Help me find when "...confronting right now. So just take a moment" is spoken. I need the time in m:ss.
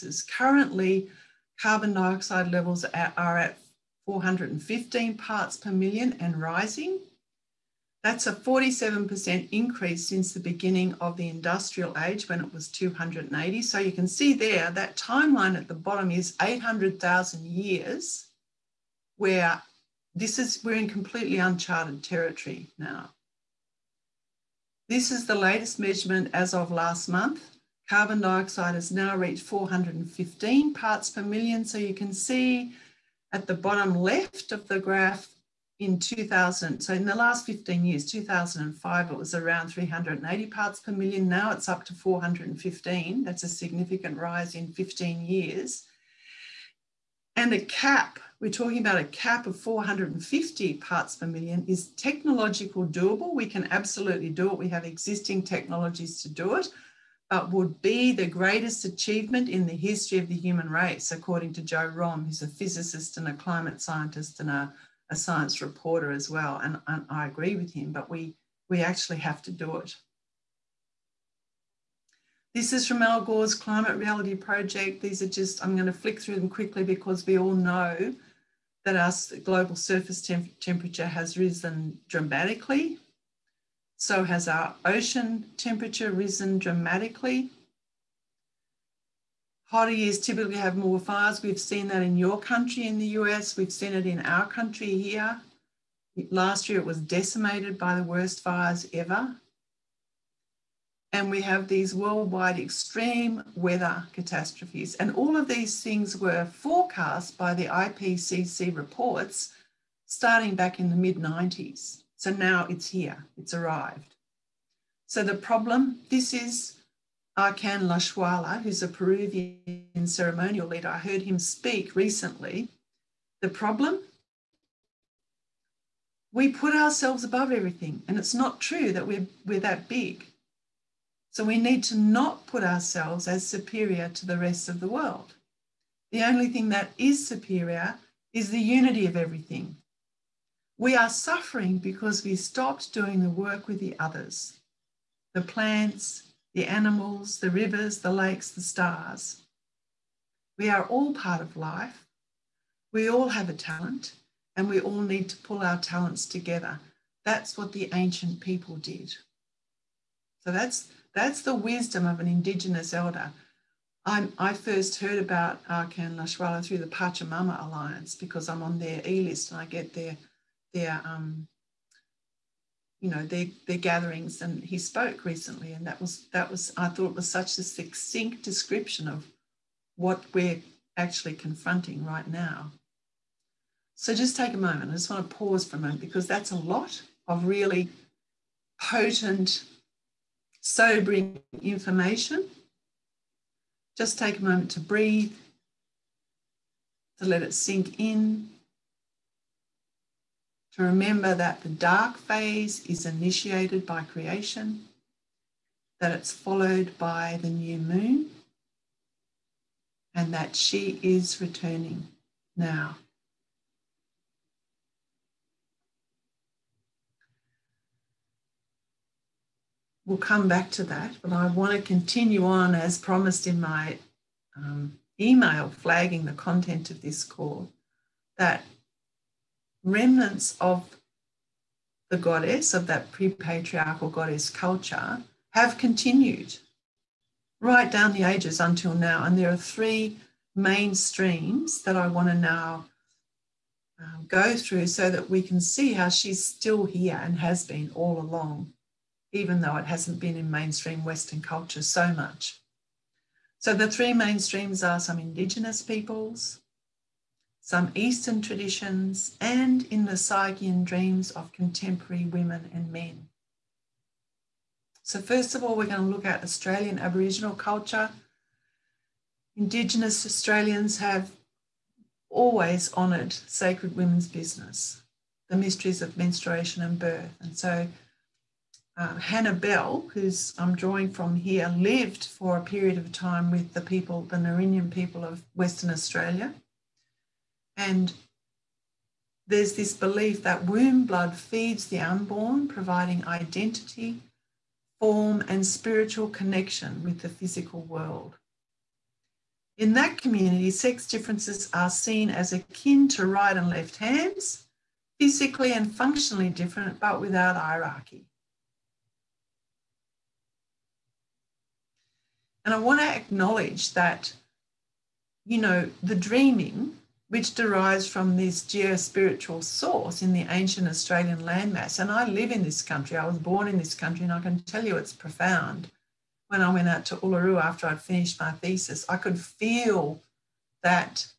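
3:01.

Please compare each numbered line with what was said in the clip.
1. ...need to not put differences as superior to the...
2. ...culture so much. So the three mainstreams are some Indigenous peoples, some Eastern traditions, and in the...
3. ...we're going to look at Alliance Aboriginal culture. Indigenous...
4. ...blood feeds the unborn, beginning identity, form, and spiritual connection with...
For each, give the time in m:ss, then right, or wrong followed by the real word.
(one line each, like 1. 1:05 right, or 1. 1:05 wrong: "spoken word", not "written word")
1. 2:11 wrong: "ourselves", not "differences"
2. 4:11 right
3. 4:25 wrong: "Australian", not "Alliance"
4. 4:51 wrong: "providing", not "beginning".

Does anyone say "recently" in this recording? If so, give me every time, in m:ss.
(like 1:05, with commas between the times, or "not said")
2:01, 2:55.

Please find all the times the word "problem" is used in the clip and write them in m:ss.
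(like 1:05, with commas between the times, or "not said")
1:55, 2:03.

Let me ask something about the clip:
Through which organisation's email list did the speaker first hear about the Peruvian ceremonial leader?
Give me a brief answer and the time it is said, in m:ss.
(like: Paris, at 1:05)
Pachamama Alliance, at 2:46.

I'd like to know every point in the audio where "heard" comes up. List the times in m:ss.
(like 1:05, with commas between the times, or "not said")
2:00, 2:45.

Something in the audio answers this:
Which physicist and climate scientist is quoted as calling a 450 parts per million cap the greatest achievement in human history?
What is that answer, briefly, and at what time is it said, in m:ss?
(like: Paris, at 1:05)
Joe Romm, at 1:01.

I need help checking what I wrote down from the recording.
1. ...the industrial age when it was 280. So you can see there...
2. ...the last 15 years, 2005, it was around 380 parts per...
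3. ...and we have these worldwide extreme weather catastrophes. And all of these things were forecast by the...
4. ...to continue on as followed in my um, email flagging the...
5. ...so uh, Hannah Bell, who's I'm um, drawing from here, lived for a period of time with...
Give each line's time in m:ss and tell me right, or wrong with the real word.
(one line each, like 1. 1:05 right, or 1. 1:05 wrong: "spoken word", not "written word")
1. 0:11 right
2. 0:37 right
3. 1:41 right
4. 3:41 wrong: "promised", not "followed"
5. 4:37 right.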